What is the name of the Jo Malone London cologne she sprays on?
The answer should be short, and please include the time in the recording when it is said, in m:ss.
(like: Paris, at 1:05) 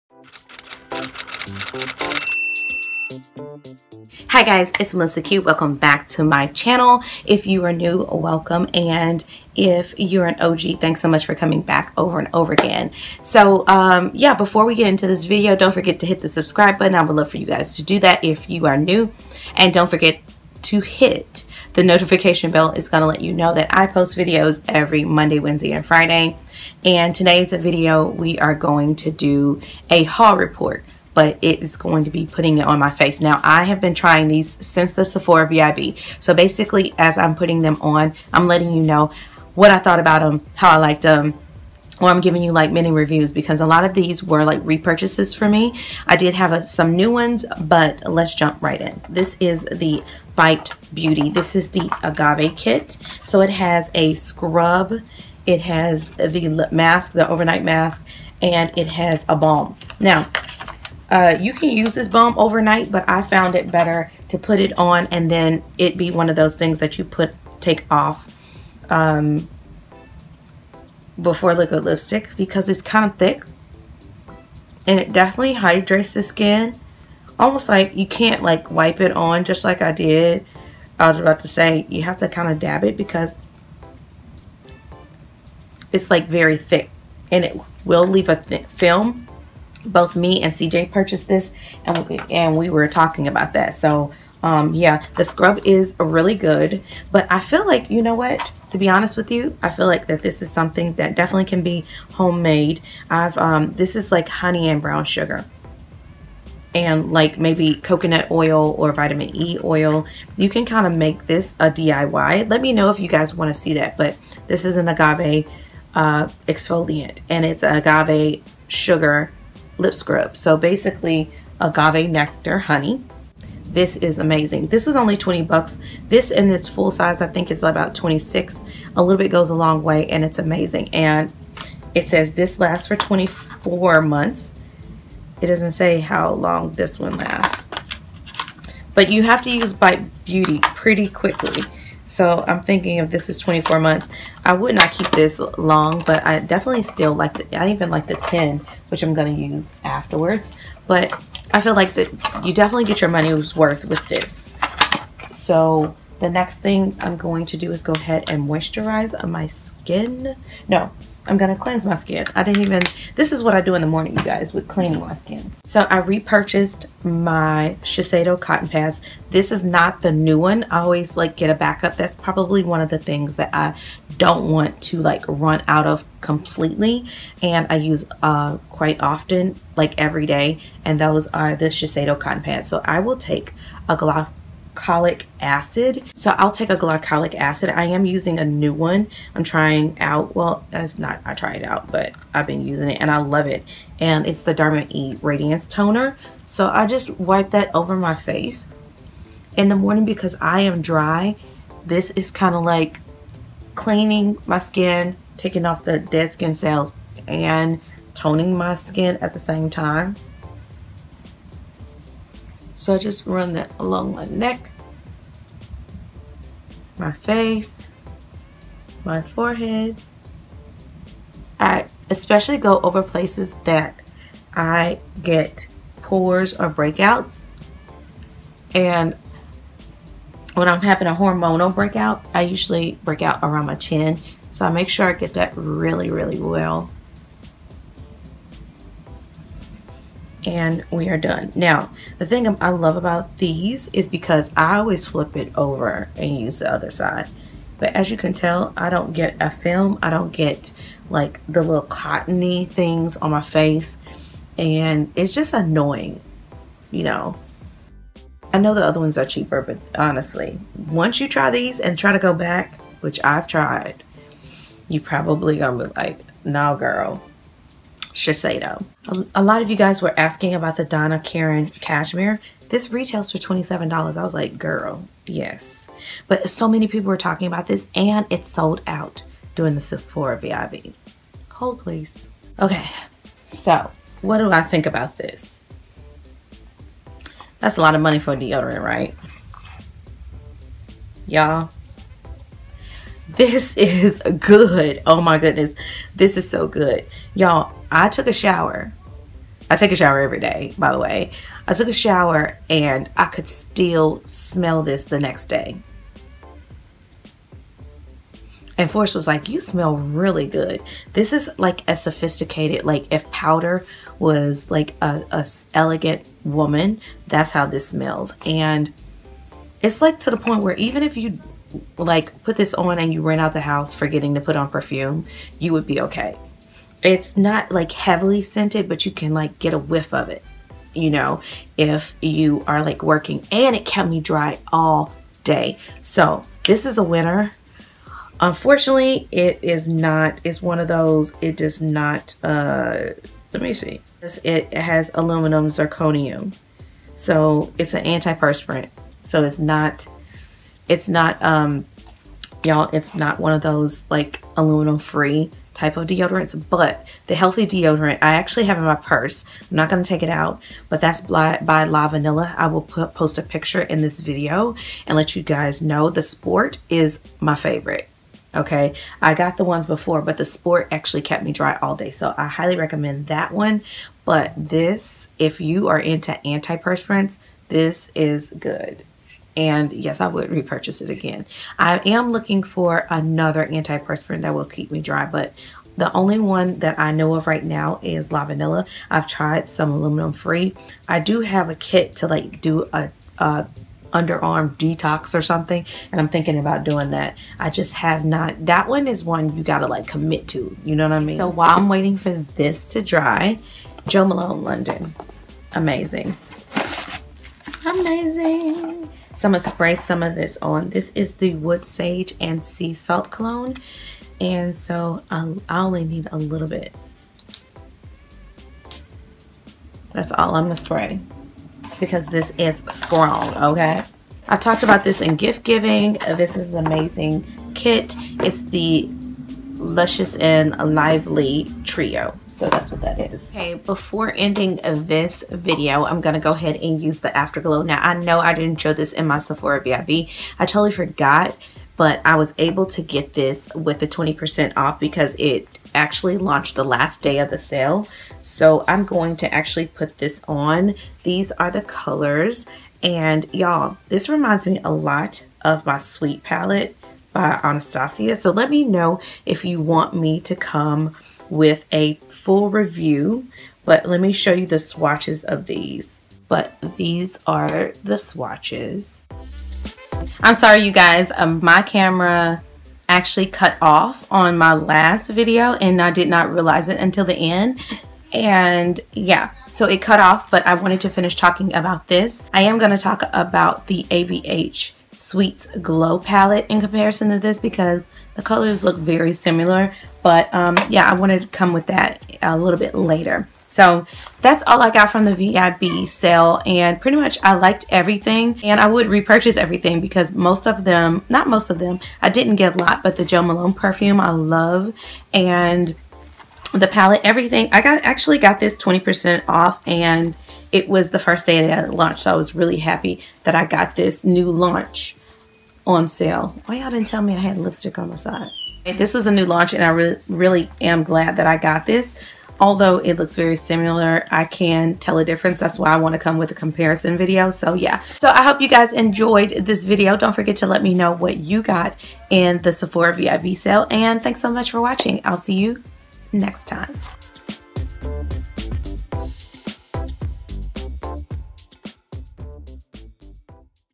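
Wood Sage and Sea Salt, at 6:51.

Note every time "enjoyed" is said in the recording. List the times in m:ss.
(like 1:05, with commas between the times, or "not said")
8:48.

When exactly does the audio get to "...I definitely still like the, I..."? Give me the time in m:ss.
2:26.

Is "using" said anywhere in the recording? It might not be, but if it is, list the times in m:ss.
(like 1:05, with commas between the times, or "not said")
3:08, 3:12.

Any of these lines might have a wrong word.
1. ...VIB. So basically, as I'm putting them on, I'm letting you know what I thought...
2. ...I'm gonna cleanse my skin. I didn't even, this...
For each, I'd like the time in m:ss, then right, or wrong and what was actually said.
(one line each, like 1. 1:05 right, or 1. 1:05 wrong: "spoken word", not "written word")
1. 0:35 right
2. 2:41 right.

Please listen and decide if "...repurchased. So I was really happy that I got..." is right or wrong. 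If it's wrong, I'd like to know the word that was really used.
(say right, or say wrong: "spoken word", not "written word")
wrong: "launched", not "repurchased".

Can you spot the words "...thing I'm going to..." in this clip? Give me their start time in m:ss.
2:36.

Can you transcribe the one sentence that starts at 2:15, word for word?
It doesn't say how long this one lasts.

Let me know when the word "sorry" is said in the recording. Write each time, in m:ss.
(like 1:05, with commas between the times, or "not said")
7:50.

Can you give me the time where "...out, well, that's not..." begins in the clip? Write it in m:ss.
3:09.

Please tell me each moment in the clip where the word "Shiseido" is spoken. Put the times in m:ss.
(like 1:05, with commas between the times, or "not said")
2:47, 3:01, 4:28.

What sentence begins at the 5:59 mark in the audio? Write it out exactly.
I'm not going to take it out, but that's by, by Lavanilla.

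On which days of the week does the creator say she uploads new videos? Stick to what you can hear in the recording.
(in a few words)
Monday, Wednesday, and Friday.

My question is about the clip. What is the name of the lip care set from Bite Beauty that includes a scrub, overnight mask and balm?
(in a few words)
Agave Kit.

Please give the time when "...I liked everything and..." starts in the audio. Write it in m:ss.
8:17.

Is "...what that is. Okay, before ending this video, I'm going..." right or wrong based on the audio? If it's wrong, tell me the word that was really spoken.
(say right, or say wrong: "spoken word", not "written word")
right.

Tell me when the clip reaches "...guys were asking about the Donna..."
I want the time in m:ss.
4:29.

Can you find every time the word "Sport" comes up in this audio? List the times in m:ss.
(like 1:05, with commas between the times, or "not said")
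6:06, 6:10.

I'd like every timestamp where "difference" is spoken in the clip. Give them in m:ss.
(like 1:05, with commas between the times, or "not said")
8:45.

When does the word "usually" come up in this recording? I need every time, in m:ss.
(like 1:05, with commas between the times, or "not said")
3:52.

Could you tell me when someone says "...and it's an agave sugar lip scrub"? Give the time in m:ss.
1:57.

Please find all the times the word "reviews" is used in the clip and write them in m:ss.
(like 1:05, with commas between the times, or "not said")
0:42, 7:42.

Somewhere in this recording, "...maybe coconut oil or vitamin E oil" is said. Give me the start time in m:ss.
1:47.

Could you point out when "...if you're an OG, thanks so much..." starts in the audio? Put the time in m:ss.
0:09.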